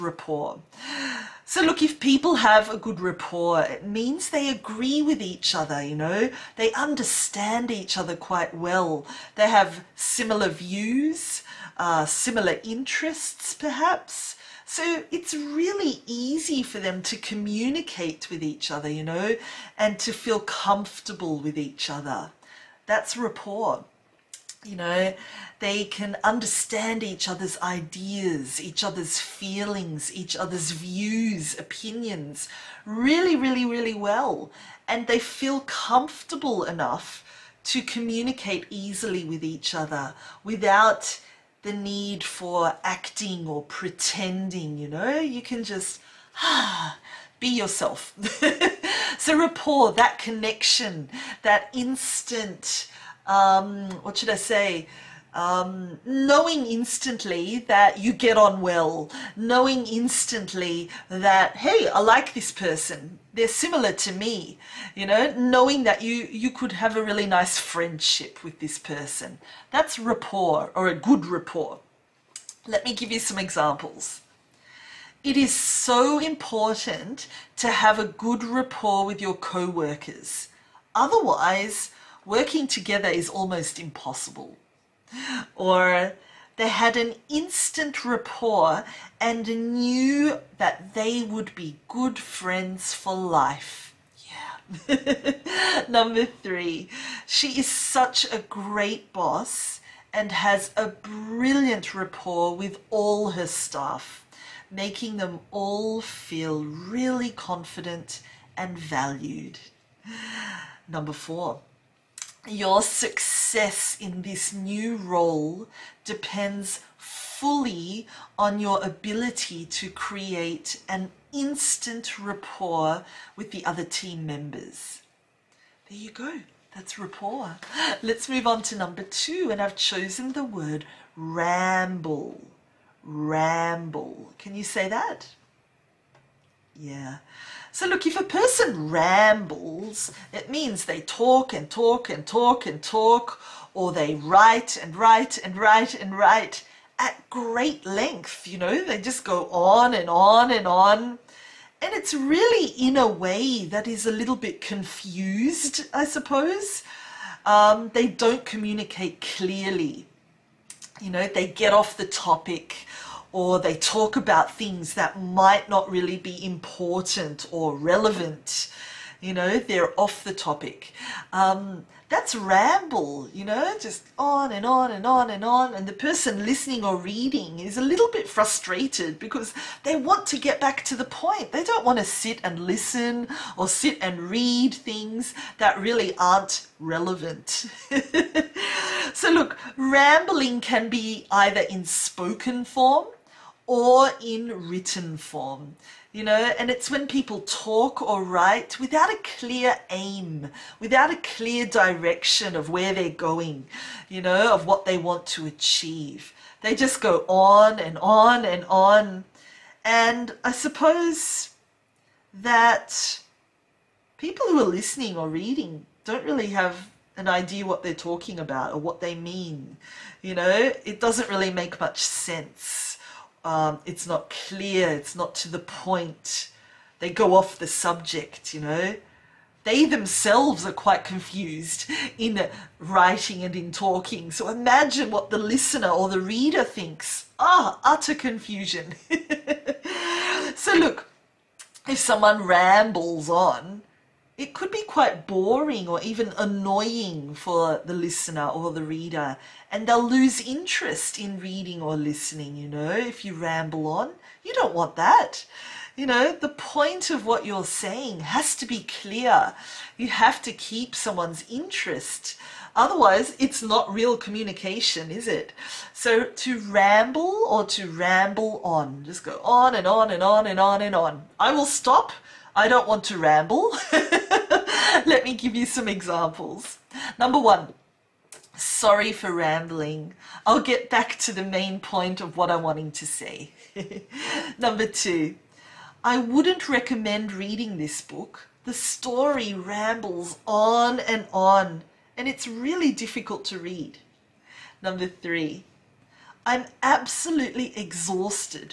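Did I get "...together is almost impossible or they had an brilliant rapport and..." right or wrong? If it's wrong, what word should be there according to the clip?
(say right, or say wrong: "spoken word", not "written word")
wrong: "instant", not "brilliant".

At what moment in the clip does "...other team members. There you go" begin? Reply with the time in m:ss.
2:03.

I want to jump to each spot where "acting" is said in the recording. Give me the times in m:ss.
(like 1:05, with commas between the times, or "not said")
0:42.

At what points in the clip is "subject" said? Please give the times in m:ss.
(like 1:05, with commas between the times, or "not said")
3:47.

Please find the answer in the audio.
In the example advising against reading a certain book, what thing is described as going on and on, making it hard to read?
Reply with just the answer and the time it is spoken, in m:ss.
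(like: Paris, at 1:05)
the story, at 4:48.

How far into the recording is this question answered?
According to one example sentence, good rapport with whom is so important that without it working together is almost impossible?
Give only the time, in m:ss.
1:19.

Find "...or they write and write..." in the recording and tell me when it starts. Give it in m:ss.
2:23.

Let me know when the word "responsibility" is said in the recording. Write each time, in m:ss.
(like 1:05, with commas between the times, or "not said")
not said.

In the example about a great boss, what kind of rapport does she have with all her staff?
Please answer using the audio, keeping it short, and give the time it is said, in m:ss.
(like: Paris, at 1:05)
brilliant, at 1:40.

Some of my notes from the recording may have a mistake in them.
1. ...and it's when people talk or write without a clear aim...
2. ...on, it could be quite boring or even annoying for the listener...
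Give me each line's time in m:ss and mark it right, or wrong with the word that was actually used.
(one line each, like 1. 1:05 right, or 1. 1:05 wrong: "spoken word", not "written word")
1. 3:16 right
2. 4:03 right.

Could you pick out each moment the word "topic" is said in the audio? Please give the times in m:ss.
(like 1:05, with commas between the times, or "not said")
2:42, 2:50.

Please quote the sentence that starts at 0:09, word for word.
They have similar views, uh, similar interests, perhaps.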